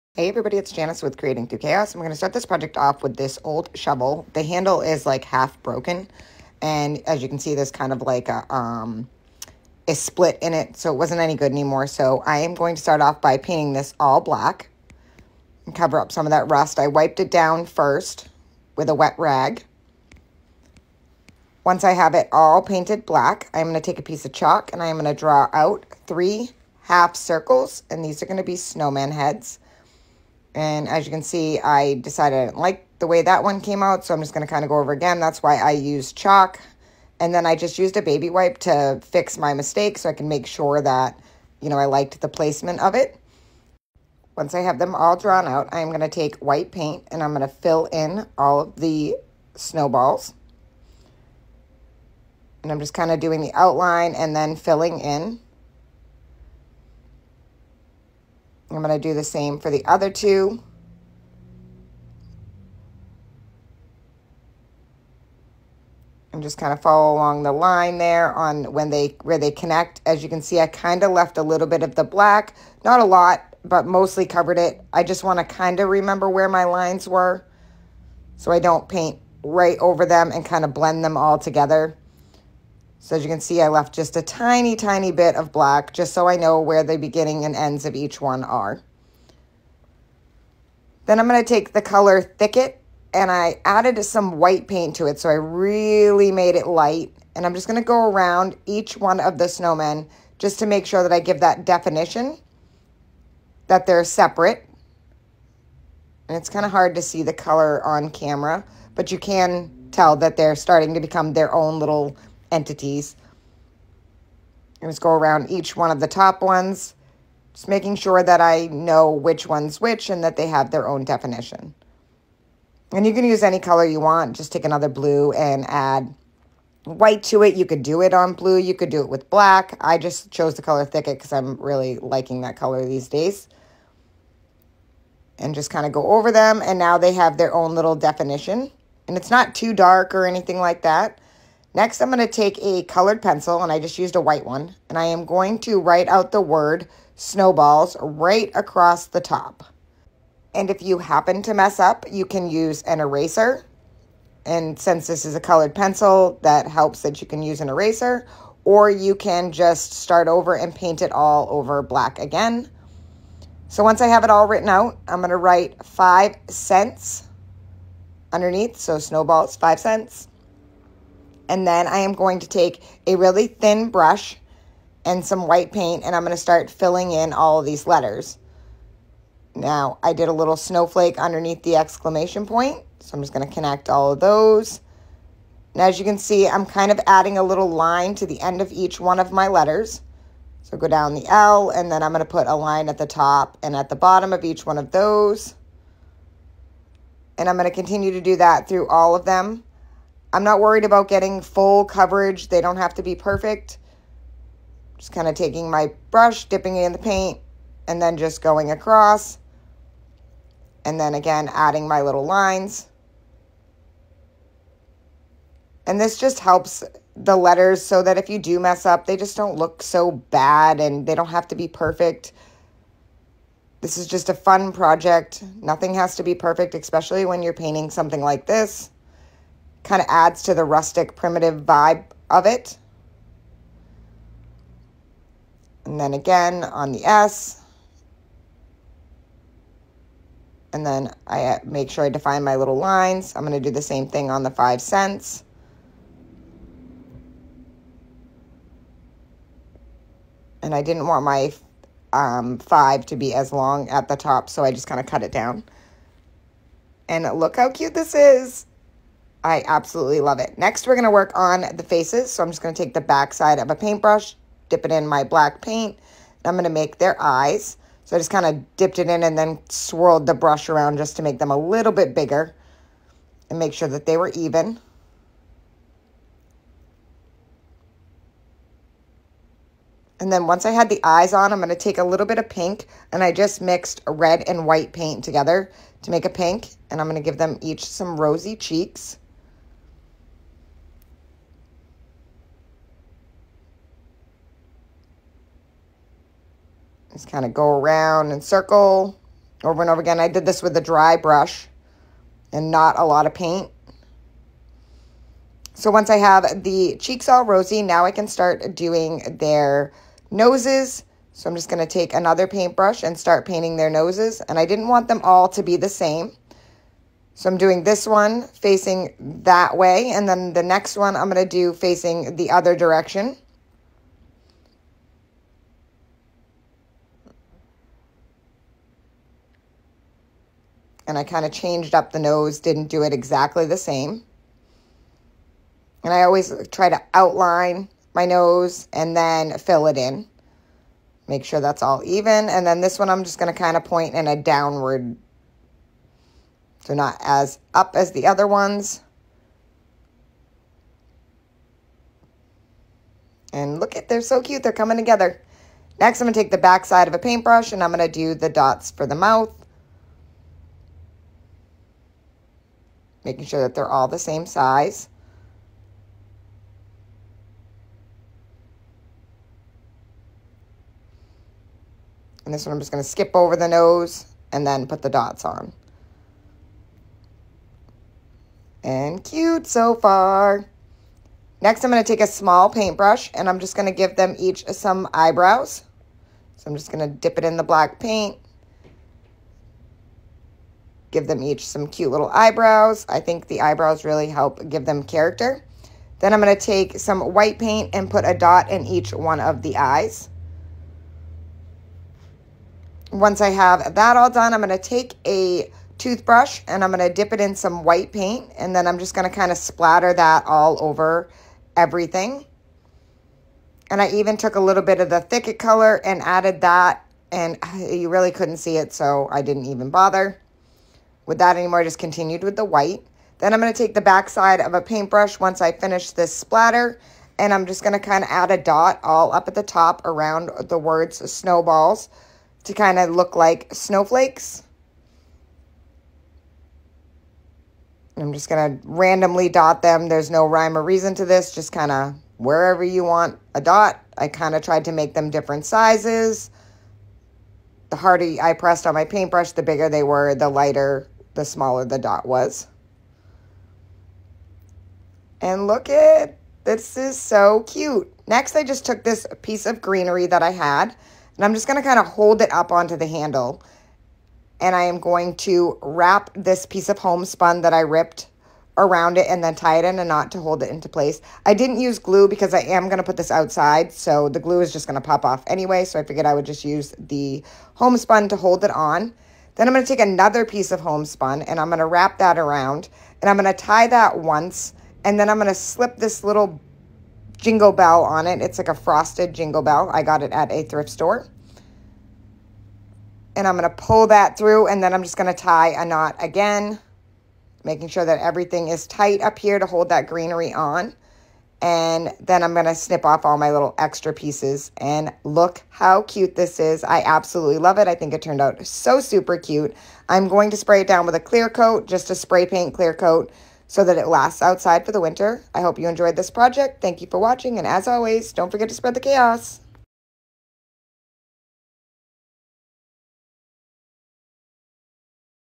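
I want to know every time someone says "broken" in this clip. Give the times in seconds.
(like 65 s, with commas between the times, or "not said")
5 s.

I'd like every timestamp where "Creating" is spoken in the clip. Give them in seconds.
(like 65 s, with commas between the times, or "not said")
1 s.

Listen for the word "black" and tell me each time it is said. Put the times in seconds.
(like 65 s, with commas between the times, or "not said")
14 s, 23 s, 72 s, 85 s, 129 s, 161 s, 265 s, 387 s.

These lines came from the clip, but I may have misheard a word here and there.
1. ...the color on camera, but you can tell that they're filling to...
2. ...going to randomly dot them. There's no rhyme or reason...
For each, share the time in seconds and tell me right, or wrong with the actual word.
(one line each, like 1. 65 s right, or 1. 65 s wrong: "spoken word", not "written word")
1. 107 s wrong: "starting", not "filling"
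2. 438 s right.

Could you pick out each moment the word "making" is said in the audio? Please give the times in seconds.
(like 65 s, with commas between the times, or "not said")
117 s, 363 s, 497 s.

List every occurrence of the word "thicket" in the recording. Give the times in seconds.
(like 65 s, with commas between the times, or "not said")
92 s, 130 s, 415 s.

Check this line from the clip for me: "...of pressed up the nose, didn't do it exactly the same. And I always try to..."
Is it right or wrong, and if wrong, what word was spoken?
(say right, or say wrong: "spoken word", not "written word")
wrong: "changed", not "pressed".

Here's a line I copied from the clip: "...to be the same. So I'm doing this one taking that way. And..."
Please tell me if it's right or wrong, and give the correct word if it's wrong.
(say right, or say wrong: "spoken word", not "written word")
wrong: "facing", not "taking".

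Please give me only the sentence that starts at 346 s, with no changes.
So not as up as the other ones.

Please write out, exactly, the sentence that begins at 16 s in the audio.
I wiped it down first with a wet rag.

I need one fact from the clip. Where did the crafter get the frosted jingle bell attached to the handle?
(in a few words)
thrift store.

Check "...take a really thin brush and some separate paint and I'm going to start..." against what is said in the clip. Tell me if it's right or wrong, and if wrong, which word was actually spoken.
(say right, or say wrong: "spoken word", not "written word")
wrong: "white", not "separate".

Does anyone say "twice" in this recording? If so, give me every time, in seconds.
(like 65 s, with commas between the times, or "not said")
not said.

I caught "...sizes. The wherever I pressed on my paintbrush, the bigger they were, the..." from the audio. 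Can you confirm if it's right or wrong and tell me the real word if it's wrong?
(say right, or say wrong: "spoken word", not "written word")
wrong: "harder", not "wherever".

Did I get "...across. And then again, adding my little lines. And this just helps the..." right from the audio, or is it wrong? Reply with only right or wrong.
right.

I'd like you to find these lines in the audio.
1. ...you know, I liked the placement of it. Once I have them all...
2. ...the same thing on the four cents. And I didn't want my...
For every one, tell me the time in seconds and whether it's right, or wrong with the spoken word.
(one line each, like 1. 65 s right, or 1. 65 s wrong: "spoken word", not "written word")
1. 41 s right
2. 243 s wrong: "five", not "four".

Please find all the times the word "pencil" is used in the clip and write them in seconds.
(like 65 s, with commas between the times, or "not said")
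143 s, 155 s.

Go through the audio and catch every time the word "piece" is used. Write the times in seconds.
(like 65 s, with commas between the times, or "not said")
24 s, 459 s, 466 s, 480 s, 504 s.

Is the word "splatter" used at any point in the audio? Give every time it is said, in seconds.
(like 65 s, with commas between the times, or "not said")
409 s, 426 s.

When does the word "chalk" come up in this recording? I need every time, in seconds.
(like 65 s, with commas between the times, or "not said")
24 s, 36 s.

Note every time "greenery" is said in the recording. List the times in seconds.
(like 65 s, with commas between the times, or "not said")
459 s, 500 s.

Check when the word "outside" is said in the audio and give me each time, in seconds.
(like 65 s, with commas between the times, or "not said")
473 s, 514 s.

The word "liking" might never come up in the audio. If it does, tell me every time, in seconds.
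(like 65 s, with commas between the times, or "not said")
131 s.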